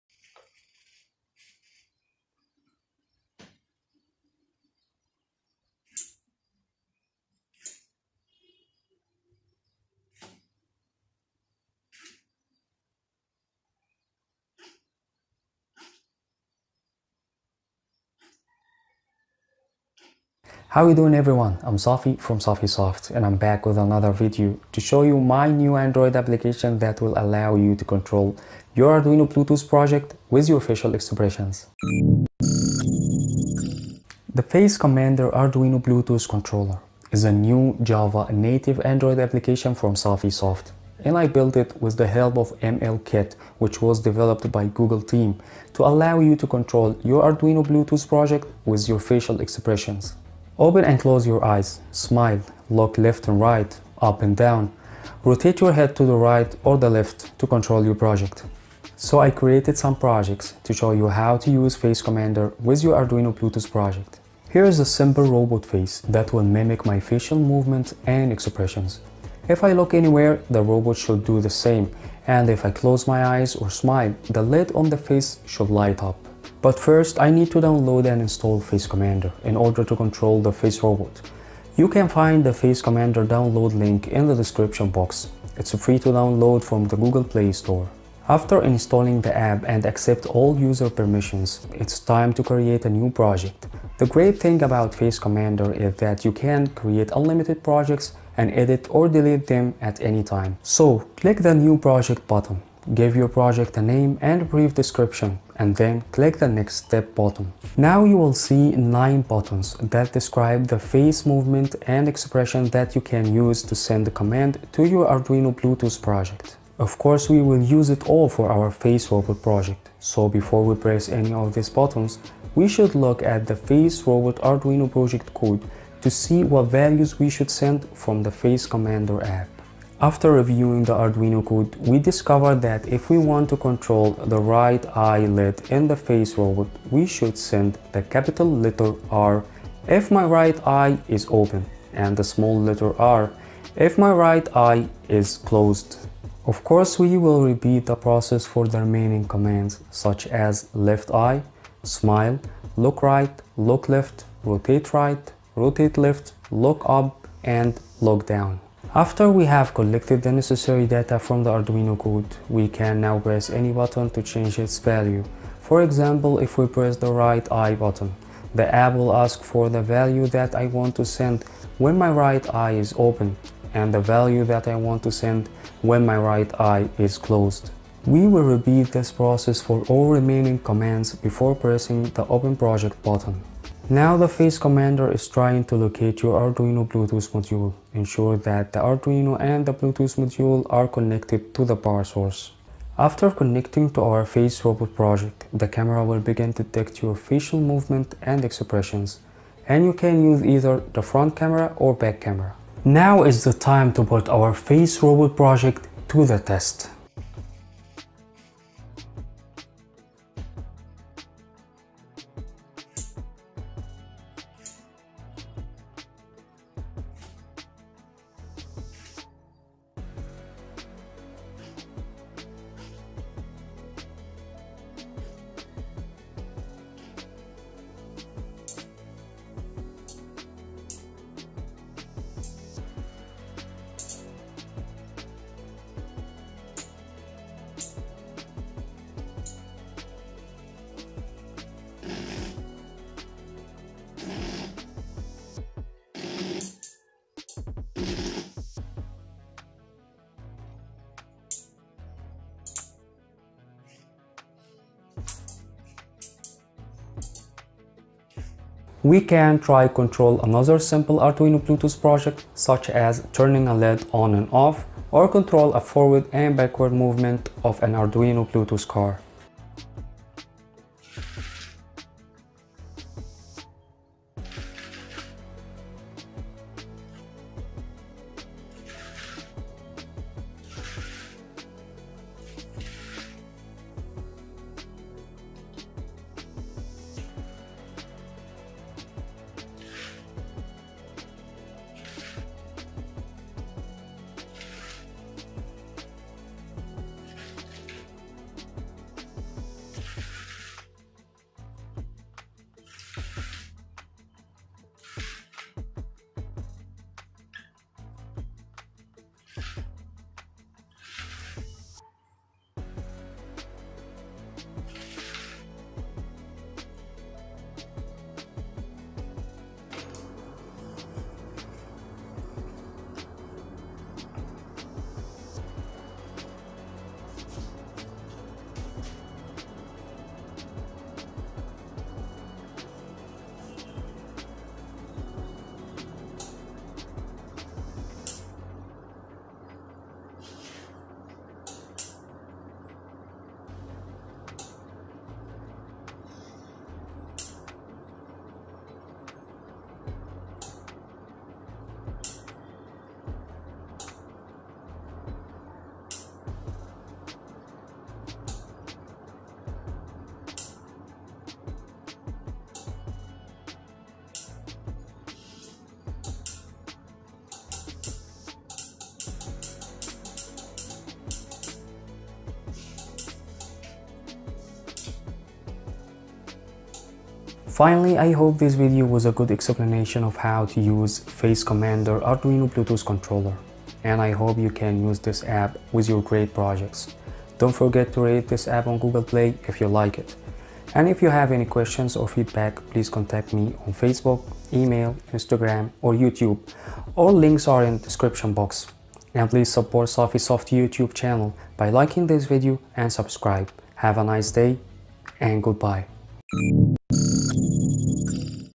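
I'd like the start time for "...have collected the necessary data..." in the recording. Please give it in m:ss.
2:39.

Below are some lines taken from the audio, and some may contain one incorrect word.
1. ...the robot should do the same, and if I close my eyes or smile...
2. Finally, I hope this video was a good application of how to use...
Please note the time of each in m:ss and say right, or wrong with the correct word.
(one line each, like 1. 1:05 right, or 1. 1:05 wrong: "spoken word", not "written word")
1. 1:10 right
2. 6:17 wrong: "explanation", not "application".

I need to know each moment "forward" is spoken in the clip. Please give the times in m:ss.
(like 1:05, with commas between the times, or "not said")
4:25.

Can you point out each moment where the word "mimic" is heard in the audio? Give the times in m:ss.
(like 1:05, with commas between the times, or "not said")
1:06.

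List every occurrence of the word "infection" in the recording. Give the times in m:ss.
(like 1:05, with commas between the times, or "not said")
not said.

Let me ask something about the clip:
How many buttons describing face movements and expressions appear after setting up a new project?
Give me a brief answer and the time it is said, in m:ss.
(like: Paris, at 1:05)
9, at 1:48.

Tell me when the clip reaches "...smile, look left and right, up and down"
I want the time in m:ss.
0:51.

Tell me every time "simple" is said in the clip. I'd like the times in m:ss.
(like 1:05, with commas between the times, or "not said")
1:04, 4:20.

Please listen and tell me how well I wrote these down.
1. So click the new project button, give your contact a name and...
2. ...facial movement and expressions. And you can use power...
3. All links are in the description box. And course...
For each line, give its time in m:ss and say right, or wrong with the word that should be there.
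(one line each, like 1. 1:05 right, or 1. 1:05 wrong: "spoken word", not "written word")
1. 1:40 wrong: "project", not "contact"
2. 3:17 wrong: "either", not "power"
3. 6:37 wrong: "please", not "course".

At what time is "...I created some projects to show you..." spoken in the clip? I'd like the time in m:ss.
0:59.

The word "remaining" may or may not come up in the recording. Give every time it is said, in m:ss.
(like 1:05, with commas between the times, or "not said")
2:28, 3:00.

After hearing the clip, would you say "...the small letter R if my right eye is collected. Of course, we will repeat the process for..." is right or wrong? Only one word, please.
wrong.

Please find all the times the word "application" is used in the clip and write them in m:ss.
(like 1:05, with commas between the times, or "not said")
0:26, 0:39.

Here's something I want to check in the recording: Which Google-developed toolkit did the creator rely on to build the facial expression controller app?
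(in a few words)
MLKit.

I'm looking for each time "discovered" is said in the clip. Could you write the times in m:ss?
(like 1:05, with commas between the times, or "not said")
2:11.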